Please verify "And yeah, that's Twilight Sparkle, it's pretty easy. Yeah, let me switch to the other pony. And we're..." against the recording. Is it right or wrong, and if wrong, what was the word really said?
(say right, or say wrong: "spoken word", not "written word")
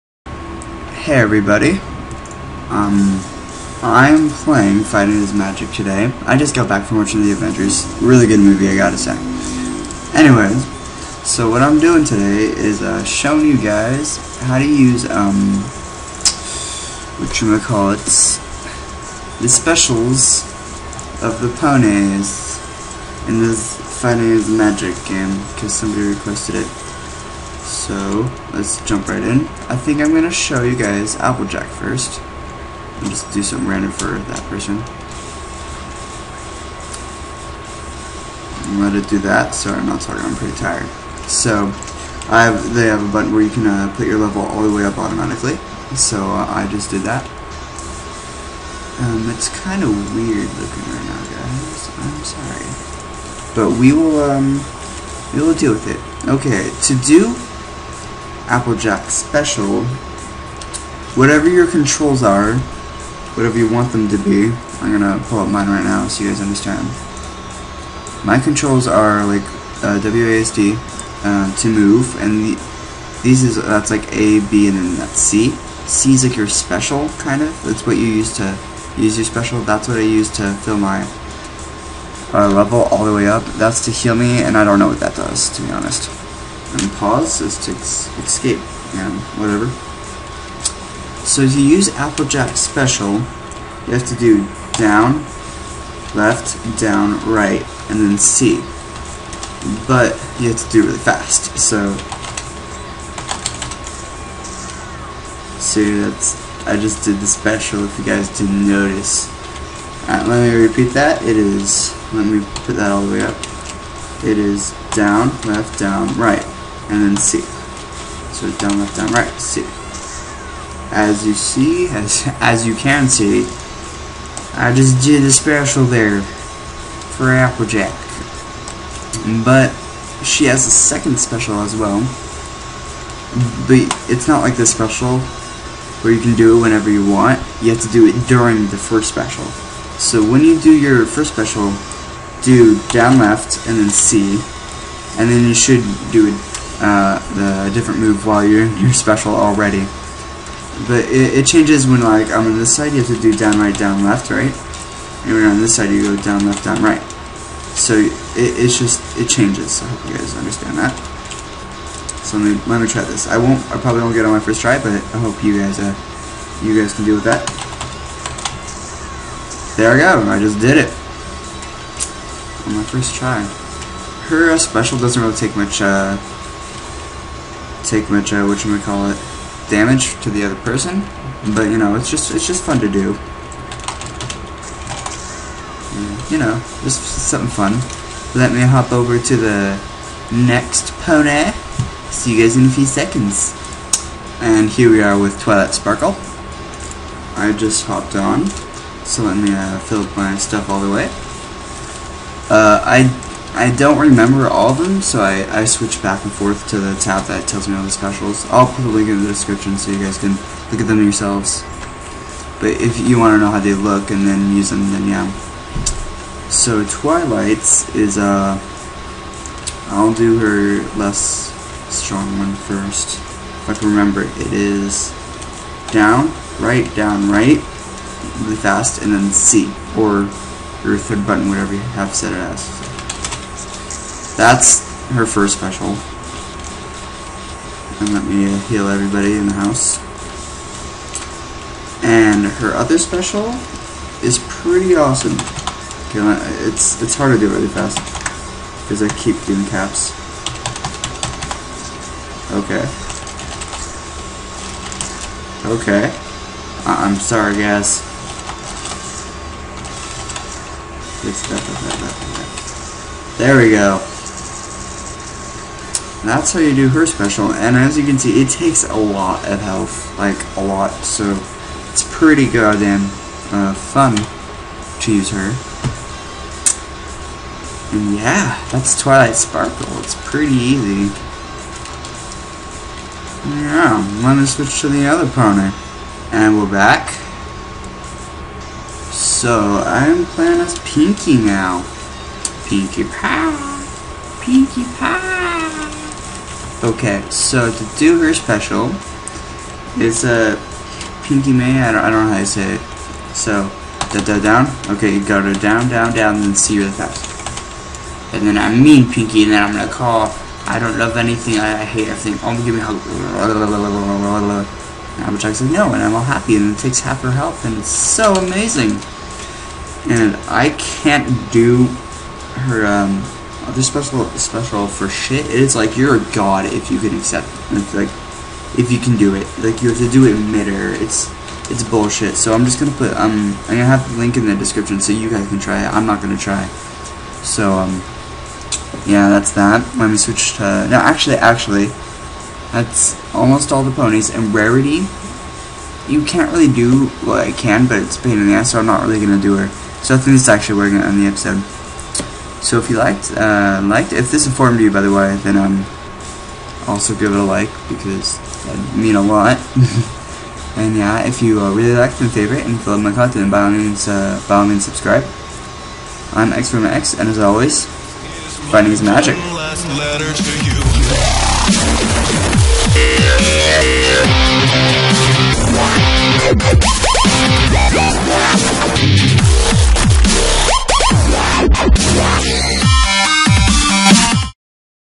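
right.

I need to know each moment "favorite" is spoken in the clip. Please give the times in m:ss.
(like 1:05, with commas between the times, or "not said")
6:02.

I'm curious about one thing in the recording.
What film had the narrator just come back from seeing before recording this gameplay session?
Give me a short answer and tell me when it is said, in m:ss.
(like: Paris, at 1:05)
The Avengers, at 0:07.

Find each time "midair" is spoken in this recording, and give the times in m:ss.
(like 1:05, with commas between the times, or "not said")
5:30.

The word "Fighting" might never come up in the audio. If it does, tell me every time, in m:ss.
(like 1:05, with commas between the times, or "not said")
0:04, 0:23.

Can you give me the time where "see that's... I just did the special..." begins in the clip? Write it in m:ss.
1:45.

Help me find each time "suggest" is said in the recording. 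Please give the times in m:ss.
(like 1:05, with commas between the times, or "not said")
not said.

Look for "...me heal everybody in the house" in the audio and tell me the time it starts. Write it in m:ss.
3:58.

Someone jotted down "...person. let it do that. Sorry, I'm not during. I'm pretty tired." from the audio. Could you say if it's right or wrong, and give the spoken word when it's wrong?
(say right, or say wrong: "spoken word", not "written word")
wrong: "talking", not "during".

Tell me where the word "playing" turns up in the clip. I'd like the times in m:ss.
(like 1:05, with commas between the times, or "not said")
0:04, 4:50.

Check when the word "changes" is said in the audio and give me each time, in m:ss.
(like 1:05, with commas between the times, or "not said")
2:31, 2:39.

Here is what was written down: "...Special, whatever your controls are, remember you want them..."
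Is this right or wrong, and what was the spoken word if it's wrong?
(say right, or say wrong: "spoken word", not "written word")
wrong: "whatever", not "remember".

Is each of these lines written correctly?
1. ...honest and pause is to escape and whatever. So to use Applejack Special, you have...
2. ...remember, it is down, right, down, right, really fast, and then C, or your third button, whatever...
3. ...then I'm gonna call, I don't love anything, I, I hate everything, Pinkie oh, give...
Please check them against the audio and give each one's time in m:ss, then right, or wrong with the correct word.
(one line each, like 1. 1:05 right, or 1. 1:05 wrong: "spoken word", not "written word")
1. 1:25 right
2. 3:43 right
3. 5:09 wrong: "Only", not "Pinkie".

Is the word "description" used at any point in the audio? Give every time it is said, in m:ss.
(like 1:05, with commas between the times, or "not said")
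3:29, 5:34.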